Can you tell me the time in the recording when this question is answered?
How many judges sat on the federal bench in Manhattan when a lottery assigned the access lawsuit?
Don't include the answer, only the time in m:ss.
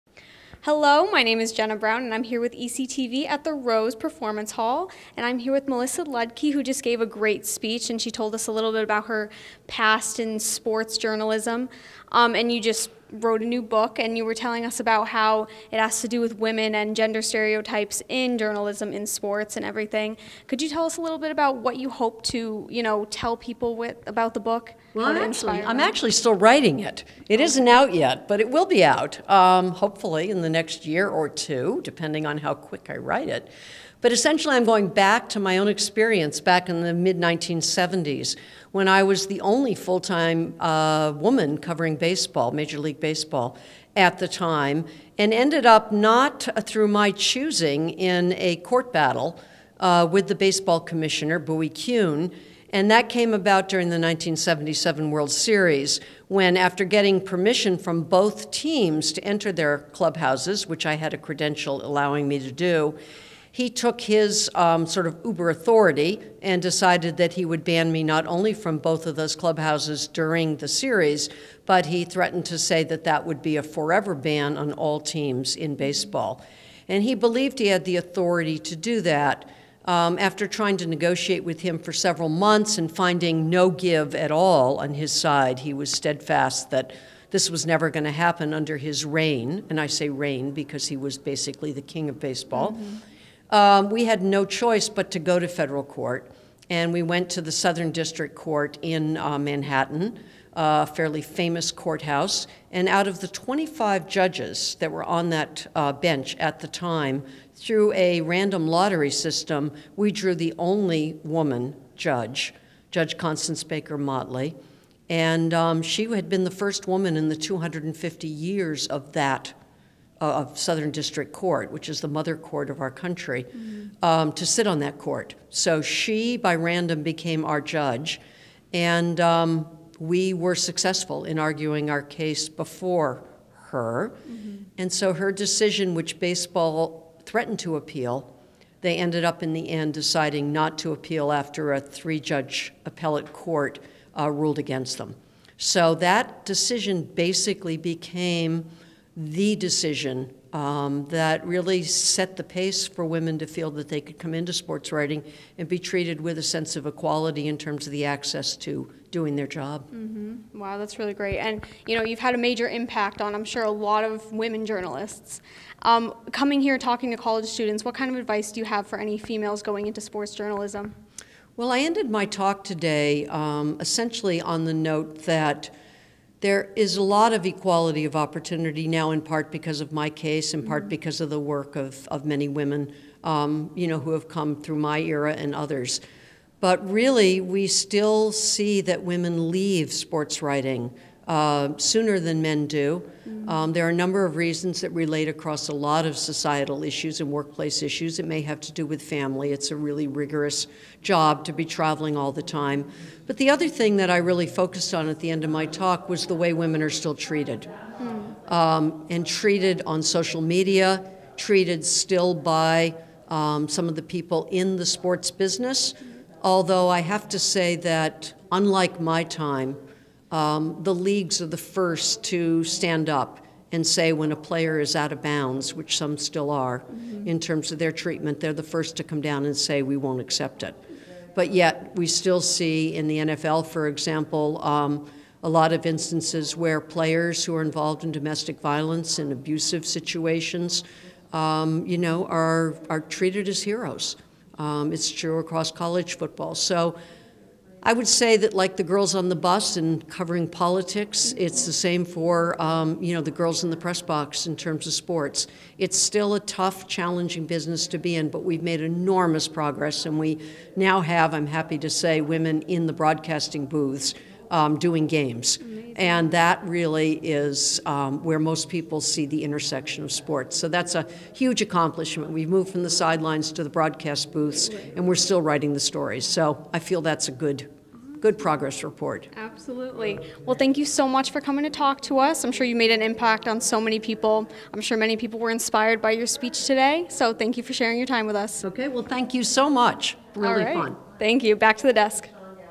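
1:43.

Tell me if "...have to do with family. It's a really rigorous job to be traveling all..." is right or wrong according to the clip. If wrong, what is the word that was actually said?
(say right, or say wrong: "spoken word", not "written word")
right.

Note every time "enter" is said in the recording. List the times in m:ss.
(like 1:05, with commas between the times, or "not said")
0:59.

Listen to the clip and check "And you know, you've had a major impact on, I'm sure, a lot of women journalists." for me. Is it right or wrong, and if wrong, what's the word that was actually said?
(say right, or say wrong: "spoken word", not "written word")
right.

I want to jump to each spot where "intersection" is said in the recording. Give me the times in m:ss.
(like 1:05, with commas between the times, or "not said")
4:29.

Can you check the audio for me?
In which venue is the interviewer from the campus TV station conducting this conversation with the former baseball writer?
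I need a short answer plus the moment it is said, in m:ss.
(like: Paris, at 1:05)
Rose Performance Hall, at 0:03.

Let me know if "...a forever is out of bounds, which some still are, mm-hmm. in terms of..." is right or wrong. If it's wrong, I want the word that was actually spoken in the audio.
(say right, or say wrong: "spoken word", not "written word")
wrong: "player", not "forever".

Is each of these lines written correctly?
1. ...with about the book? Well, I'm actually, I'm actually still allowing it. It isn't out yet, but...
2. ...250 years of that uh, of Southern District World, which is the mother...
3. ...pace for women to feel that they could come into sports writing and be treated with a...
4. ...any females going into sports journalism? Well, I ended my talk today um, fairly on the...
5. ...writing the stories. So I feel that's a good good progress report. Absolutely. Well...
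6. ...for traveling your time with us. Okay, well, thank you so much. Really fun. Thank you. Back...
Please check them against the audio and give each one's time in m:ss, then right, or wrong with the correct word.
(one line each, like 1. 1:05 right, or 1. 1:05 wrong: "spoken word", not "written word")
1. 0:23 wrong: "writing", not "allowing"
2. 1:57 wrong: "Court", not "World"
3. 2:32 right
4. 2:48 wrong: "essentially", not "fairly"
5. 4:35 right
6. 4:47 wrong: "sharing", not "traveling".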